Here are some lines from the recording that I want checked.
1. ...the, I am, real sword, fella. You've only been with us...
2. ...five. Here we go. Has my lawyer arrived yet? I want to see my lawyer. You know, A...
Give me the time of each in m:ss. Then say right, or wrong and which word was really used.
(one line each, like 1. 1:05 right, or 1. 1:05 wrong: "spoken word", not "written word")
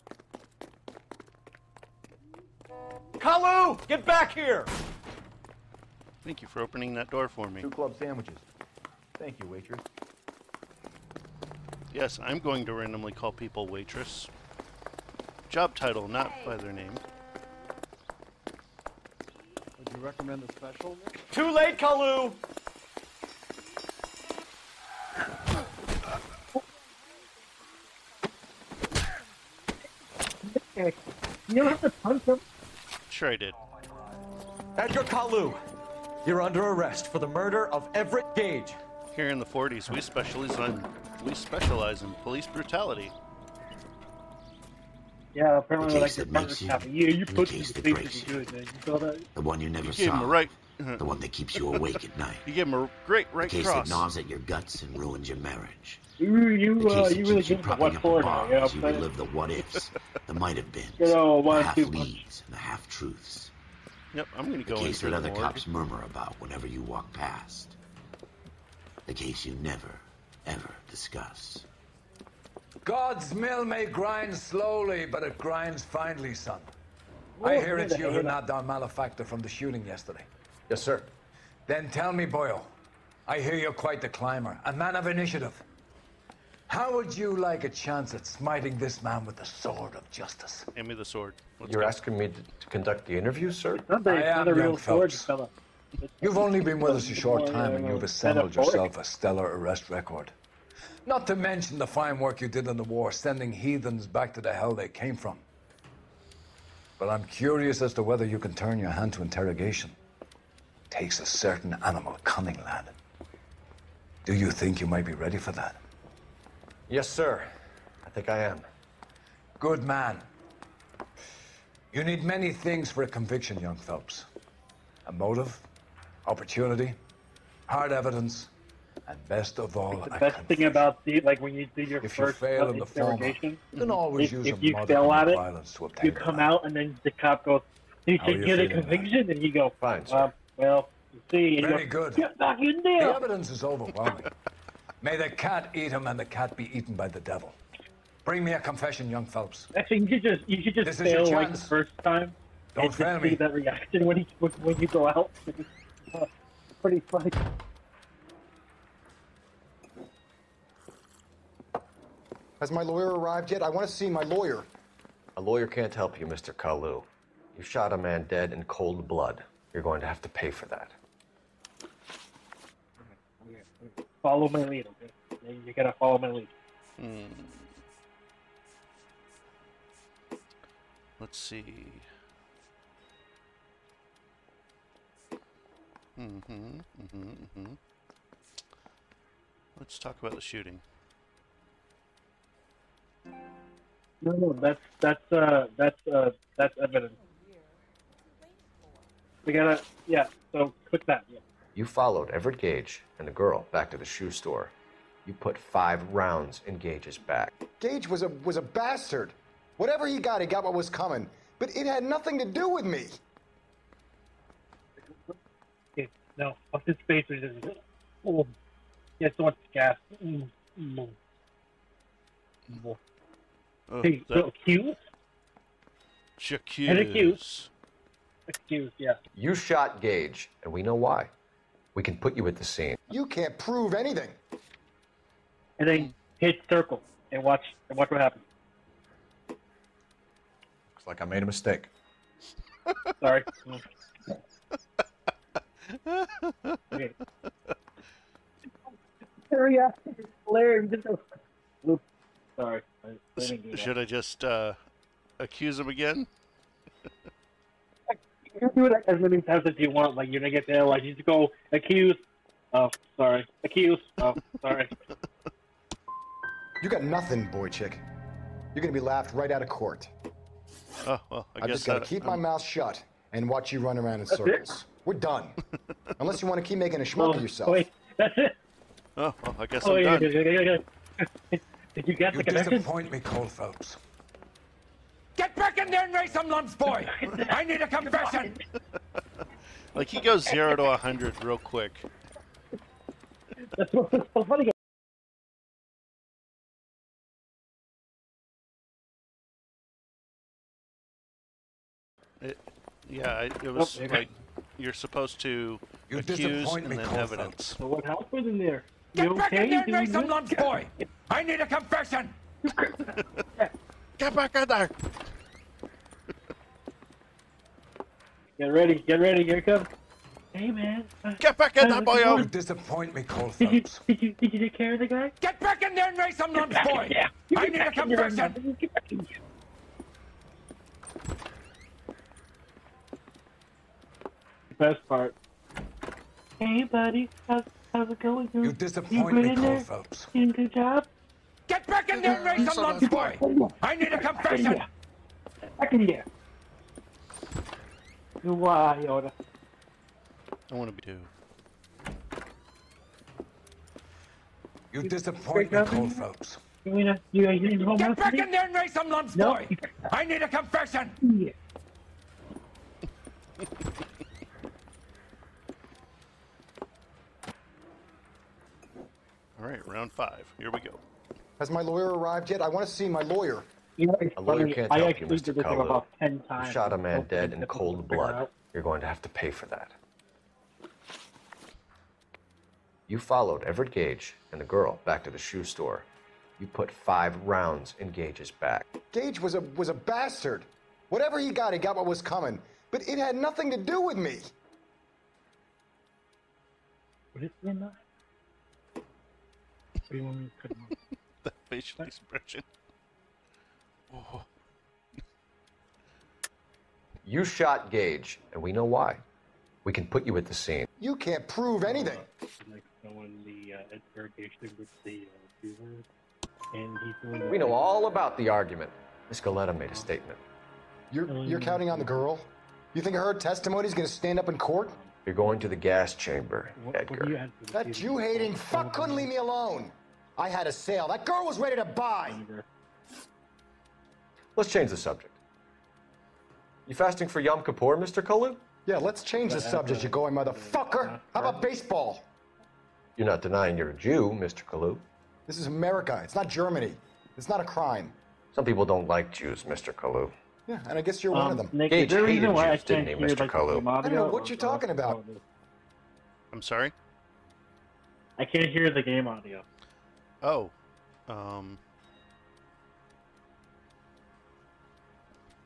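1. 1:34 right
2. 6:10 right.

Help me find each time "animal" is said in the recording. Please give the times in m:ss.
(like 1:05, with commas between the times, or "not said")
1:51.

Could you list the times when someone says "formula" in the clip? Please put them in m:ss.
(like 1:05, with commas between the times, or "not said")
not said.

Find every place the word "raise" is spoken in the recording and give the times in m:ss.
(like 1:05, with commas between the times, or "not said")
4:46, 5:42, 5:58.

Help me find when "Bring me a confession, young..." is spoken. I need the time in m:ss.
2:28.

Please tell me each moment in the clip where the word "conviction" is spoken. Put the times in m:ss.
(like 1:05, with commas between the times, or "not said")
2:03, 2:18.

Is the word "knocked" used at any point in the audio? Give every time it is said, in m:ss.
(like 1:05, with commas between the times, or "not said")
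1:18.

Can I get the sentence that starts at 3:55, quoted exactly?
And then hit circle and watch and watch what happens.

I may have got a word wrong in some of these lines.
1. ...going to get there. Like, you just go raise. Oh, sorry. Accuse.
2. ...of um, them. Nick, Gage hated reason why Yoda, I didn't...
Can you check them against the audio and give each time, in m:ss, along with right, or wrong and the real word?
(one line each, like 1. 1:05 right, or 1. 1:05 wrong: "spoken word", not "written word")
1. 4:20 wrong: "accuse", not "raise"
2. 7:31 wrong: "Jews", not "Yoda".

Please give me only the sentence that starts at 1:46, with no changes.
But I'm curious as to whether you can turn your hand to interrogation.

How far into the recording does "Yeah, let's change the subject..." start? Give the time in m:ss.
7:18.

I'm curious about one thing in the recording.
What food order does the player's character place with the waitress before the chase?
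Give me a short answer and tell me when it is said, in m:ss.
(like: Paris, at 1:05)
Two club sandwiches, at 0:07.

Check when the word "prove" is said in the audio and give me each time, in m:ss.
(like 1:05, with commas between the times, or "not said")
3:53, 6:51.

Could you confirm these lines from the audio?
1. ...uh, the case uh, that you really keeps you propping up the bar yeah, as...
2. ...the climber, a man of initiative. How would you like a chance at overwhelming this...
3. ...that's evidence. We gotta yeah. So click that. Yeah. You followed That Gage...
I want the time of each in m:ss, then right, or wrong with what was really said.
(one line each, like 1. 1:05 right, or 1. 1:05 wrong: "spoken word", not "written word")
1. 0:56 right
2. 1:24 wrong: "smiting", not "overwhelming"
3. 3:16 wrong: "Everett", not "That".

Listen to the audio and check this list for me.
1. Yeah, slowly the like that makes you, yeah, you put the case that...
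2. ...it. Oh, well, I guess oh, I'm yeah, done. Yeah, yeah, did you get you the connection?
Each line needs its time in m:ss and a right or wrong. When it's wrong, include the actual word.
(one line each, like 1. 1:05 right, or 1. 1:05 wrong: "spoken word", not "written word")
1. 0:45 wrong: "apparently", not "slowly"
2. 4:38 right.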